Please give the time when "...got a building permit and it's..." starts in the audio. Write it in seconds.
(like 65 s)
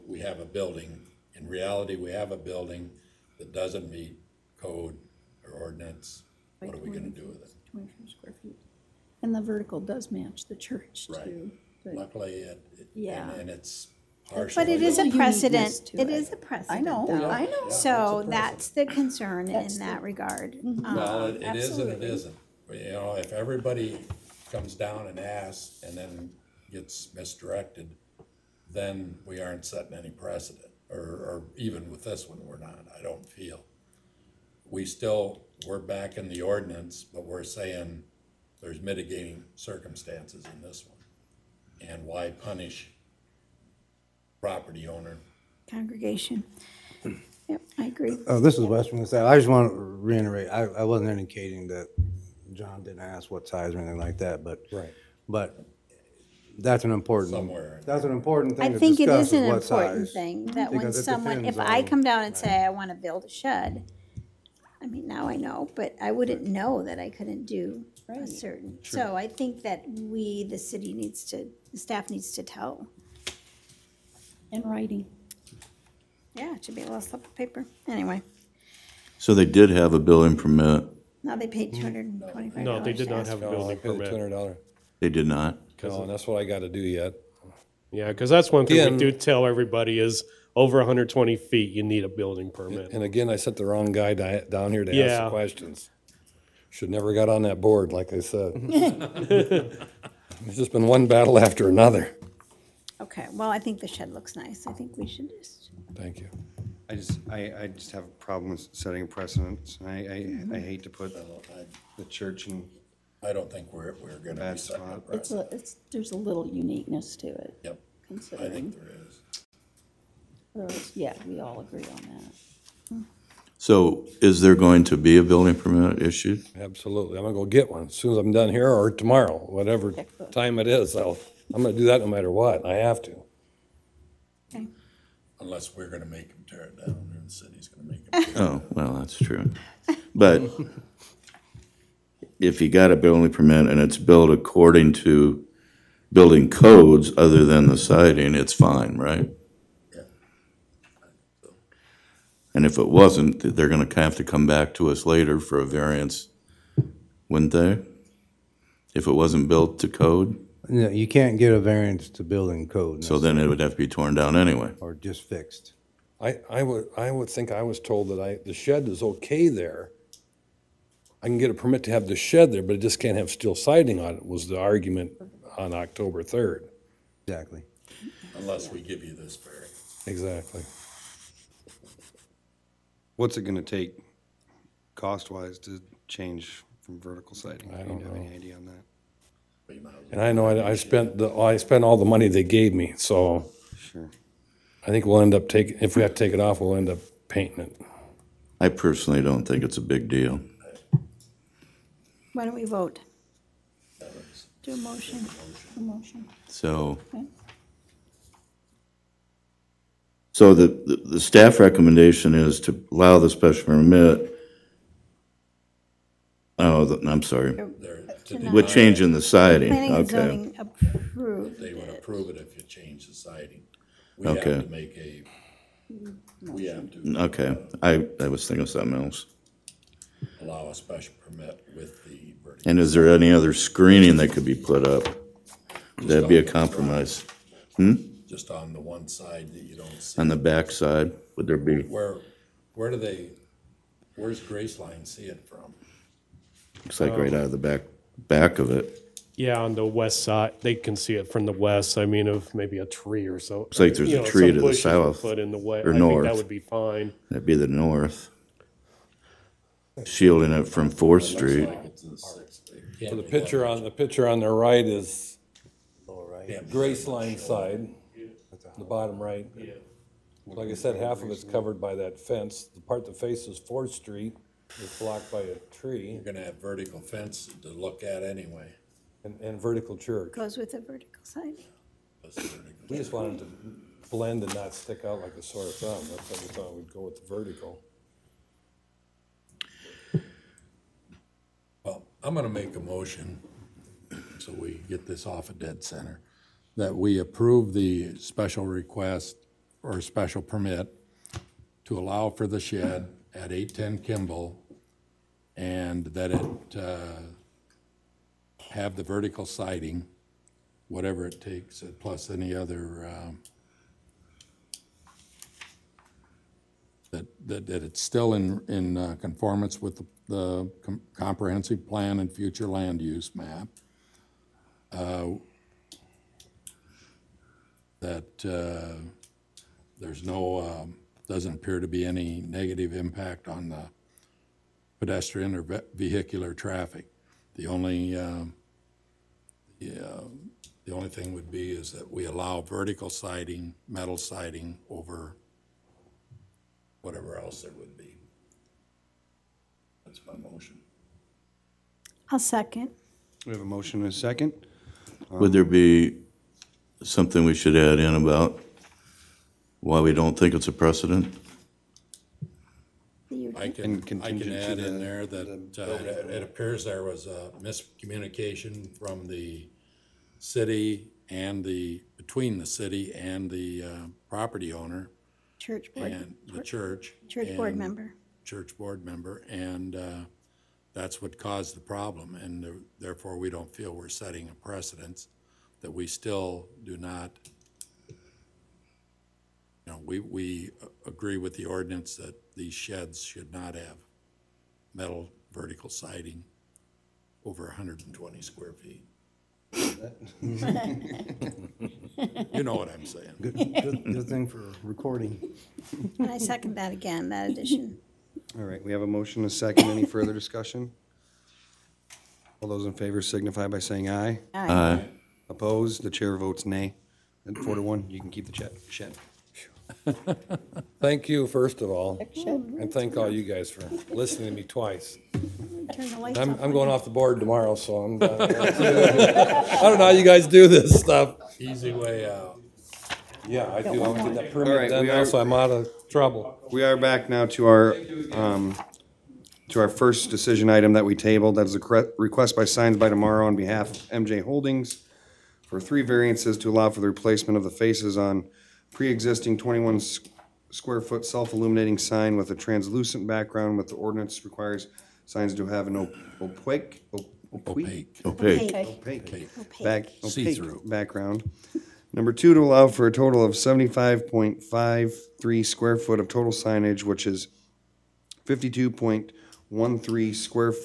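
142 s.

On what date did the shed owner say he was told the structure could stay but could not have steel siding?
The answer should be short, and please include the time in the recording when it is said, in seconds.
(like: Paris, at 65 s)
October 3rd, at 175 s.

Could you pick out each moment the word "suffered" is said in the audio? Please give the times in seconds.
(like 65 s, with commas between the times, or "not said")
not said.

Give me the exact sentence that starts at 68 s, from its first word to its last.
So I think that we, the city needs to, the staff needs to tell.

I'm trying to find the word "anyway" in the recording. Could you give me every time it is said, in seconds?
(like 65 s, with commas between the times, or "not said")
77 s, 164 s, 278 s.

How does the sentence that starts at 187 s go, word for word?
I don't Do you have know.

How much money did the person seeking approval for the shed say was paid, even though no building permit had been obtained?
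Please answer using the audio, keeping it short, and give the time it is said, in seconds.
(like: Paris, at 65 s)
$225, at 81 s.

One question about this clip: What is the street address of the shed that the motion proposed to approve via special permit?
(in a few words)
810 Kimball.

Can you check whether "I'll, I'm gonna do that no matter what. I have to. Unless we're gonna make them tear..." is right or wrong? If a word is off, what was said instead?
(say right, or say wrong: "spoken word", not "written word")
right.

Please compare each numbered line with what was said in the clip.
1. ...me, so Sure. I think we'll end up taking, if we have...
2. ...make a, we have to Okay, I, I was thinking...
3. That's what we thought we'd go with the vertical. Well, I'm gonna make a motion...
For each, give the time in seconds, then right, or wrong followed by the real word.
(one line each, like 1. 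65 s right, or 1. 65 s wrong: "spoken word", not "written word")
1. 192 s right
2. 224 s right
3. 286 s right.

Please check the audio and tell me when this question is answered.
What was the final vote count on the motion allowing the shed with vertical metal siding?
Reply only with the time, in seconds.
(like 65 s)
417 s.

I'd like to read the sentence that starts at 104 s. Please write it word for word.
I think we should just, Thank you.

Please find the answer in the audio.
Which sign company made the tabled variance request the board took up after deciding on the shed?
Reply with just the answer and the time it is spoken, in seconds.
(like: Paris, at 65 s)
Signs by Tomorrow, at 442 s.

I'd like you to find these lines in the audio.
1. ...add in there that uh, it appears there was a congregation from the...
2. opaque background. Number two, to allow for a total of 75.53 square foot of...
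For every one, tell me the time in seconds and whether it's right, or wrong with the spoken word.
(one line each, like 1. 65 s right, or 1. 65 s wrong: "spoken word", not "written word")
1. 364 s wrong: "miscommunication", not "congregation"
2. 460 s right.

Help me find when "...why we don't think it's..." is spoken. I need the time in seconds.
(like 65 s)
359 s.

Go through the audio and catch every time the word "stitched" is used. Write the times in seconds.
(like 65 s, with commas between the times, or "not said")
not said.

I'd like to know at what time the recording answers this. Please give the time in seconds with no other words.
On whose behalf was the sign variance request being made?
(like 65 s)
444 s.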